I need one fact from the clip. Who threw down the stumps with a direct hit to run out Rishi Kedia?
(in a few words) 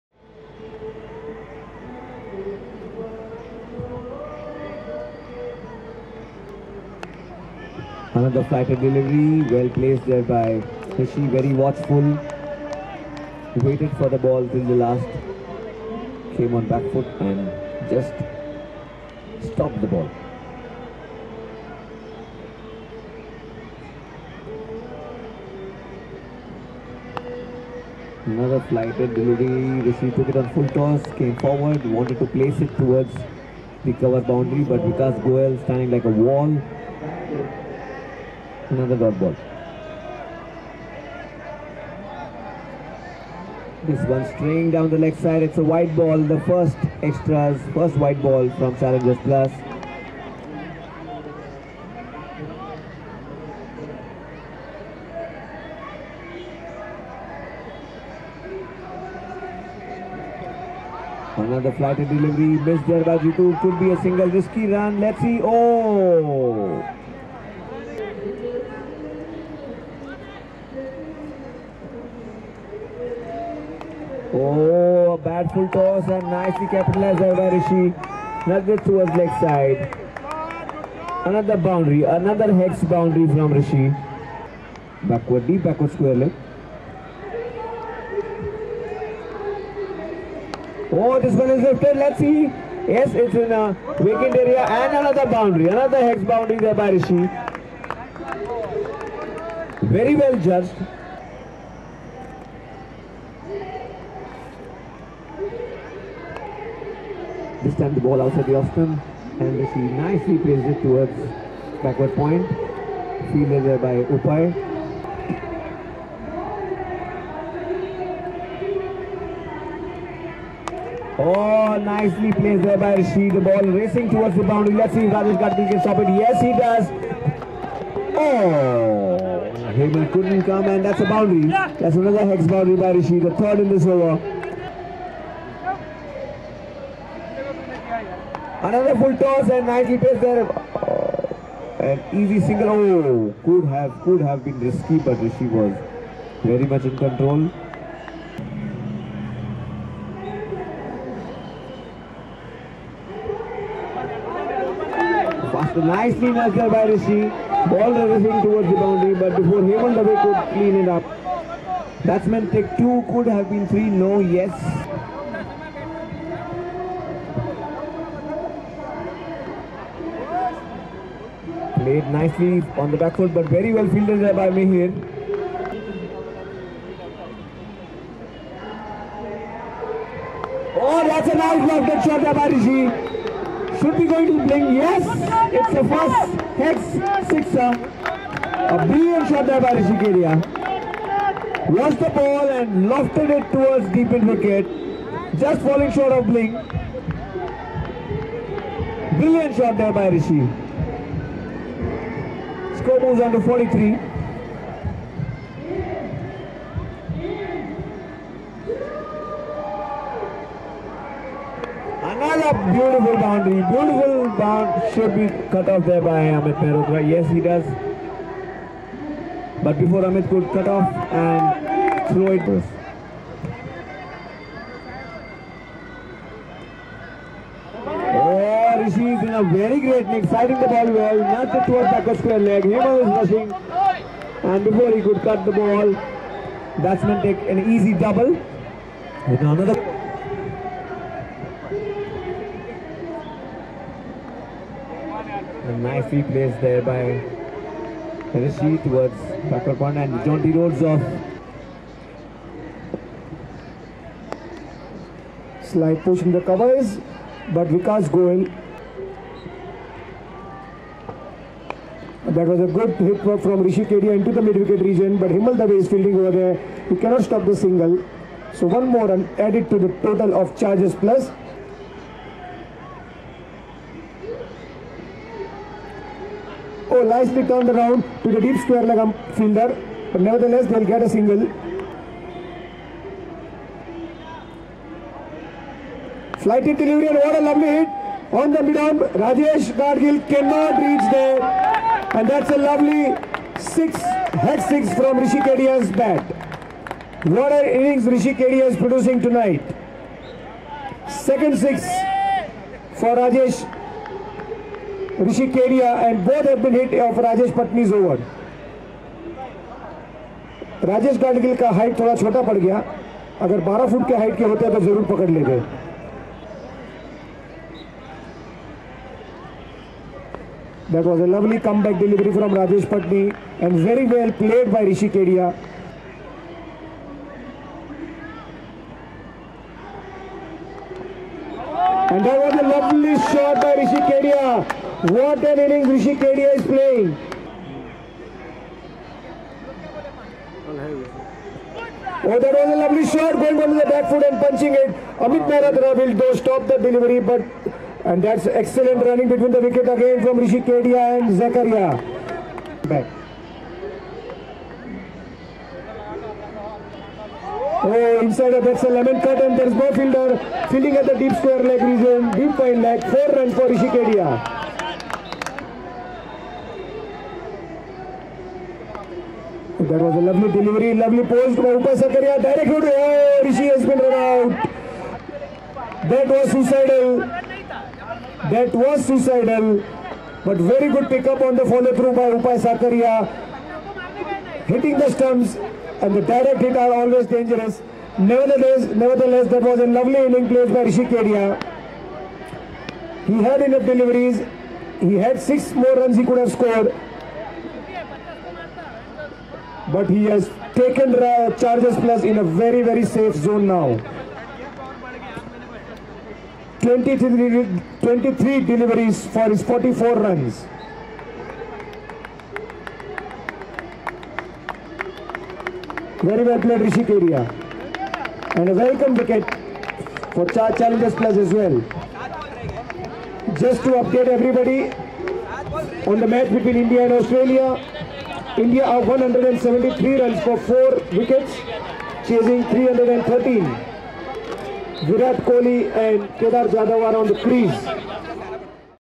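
Upai Sakaria.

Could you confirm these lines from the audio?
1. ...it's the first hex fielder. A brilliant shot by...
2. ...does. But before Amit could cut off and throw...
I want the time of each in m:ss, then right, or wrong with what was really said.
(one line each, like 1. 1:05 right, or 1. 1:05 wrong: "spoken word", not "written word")
1. 3:05 wrong: "sixer", not "fielder"
2. 3:37 right.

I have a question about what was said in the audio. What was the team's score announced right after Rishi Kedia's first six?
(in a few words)
43.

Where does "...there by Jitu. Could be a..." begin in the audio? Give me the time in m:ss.
1:02.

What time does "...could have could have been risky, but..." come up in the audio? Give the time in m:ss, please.
2:23.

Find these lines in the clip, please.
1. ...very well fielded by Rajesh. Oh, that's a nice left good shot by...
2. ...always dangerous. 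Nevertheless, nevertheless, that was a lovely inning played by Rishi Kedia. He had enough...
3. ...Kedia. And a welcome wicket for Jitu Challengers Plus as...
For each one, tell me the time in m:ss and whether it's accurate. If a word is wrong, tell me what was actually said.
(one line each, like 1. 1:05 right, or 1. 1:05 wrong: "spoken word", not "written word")
1. 2:53 wrong: "Mihir", not "Rajesh"
2. 6:26 right
3. 6:57 wrong: "Char", not "Jitu".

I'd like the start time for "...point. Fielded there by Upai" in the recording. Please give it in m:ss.
1:52.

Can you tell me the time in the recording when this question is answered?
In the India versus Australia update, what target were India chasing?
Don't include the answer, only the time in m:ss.
7:12.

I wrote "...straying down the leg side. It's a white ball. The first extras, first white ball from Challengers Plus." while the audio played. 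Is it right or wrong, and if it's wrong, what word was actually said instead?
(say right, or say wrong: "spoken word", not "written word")
right.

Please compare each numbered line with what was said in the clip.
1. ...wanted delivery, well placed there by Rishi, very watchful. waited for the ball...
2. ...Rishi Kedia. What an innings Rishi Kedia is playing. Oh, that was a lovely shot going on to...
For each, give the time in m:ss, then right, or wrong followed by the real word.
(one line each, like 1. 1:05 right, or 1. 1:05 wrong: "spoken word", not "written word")
1. 0:08 wrong: "flighted", not "wanted"
2. 5:33 right.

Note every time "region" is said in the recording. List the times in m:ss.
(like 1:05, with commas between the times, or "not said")
4:24, 6:01.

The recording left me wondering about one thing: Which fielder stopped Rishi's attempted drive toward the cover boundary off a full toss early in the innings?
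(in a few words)
Vikas Goel.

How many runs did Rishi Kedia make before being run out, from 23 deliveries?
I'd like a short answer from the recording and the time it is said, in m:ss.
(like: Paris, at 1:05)
44, at 6:49.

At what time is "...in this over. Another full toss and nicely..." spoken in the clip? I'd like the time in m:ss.
2:13.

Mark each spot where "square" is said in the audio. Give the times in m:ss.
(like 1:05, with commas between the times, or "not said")
1:25, 3:52, 4:38, 6:01.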